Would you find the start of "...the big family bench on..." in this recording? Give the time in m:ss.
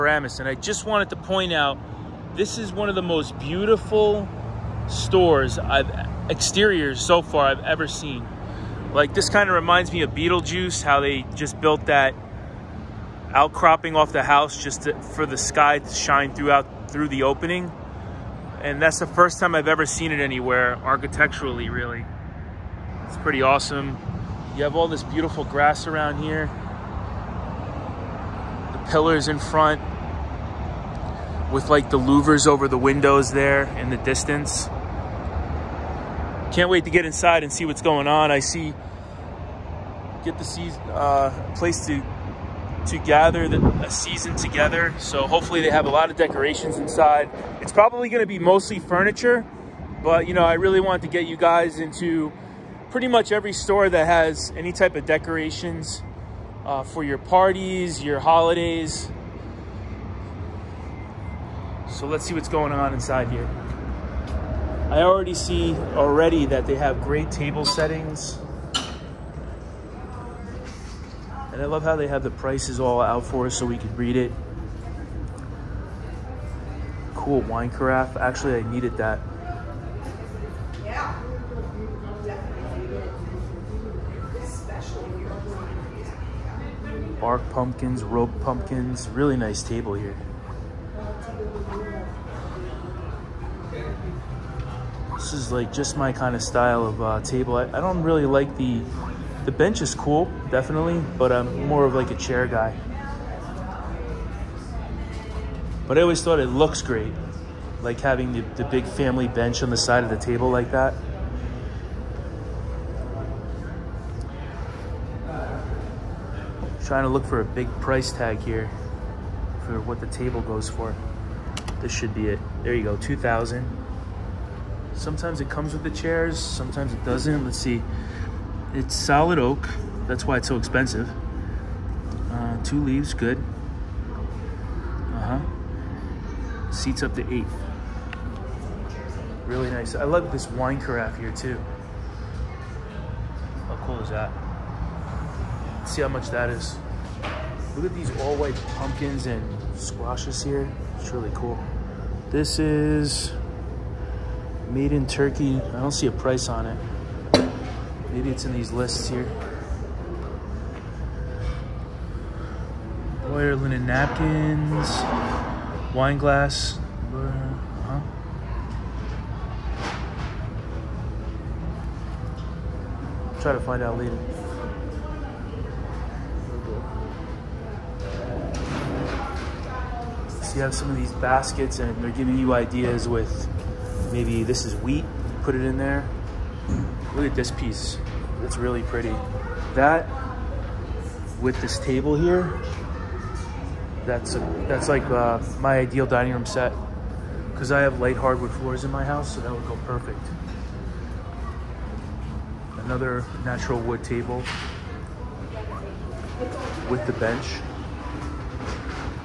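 1:48.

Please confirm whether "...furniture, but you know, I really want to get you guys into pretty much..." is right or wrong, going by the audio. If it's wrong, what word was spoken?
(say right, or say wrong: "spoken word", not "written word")
right.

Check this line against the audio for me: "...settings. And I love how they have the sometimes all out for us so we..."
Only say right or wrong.
wrong.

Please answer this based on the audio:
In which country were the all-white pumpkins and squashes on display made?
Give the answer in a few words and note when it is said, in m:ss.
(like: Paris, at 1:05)
Turkey, at 2:35.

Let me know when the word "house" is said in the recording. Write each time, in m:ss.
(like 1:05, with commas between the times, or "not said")
0:14, 3:19.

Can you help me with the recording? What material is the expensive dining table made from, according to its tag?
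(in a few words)
Solid oak.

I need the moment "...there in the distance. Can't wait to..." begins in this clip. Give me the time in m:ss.
0:33.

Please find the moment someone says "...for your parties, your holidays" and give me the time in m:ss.
0:56.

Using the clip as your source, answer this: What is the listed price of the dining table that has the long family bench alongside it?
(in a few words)
2000.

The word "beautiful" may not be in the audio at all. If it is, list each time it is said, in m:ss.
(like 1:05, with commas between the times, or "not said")
0:03, 0:25.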